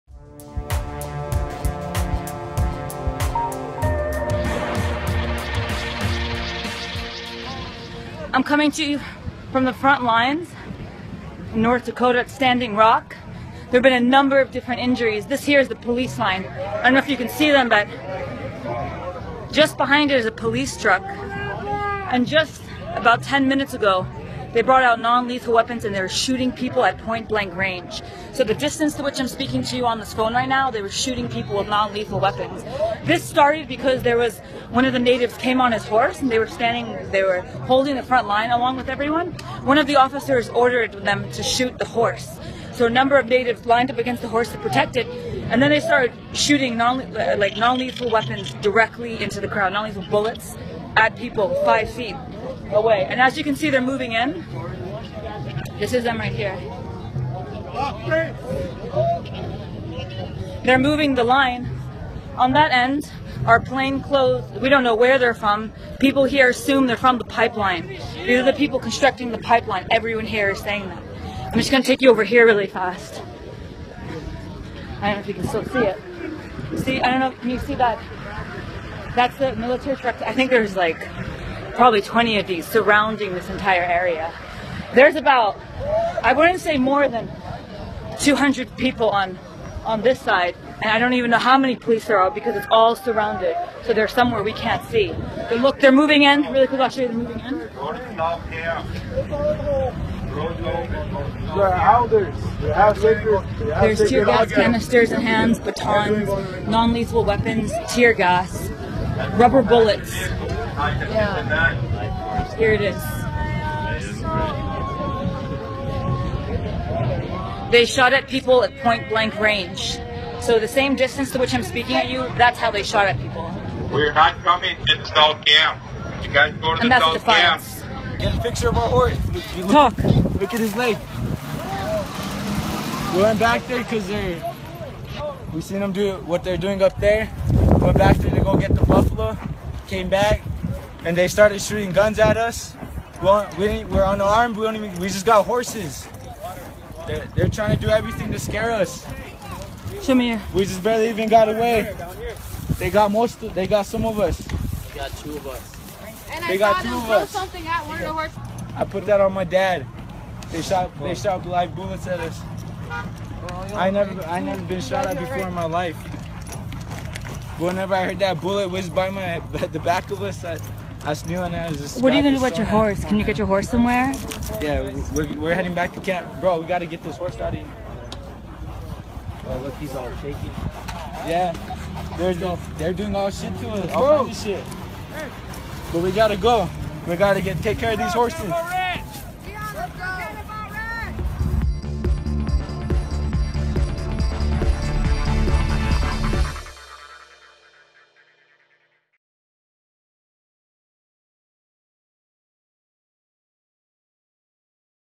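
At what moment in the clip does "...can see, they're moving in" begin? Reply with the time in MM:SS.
00:53.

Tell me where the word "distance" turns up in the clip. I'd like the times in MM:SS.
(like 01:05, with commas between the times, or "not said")
00:28, 02:00.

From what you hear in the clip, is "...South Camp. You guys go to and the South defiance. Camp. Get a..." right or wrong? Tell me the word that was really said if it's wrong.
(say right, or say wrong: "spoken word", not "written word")
right.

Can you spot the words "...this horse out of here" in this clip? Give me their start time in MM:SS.
02:57.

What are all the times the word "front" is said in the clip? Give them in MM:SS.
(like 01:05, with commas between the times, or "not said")
00:09, 00:38.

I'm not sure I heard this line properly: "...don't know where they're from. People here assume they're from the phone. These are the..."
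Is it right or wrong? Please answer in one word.
wrong.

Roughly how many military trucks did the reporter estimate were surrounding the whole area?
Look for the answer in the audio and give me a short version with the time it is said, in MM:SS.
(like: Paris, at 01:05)
20, at 01:22.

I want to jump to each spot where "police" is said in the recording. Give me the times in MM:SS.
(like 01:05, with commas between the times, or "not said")
00:15, 00:20, 01:31.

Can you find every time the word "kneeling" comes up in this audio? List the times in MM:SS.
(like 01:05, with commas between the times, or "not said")
02:51.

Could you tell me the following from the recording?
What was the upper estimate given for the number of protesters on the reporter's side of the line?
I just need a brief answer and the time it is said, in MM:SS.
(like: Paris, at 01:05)
200, at 01:28.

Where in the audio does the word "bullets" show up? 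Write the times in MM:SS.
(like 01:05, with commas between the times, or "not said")
00:50, 01:49, 02:41, 02:48.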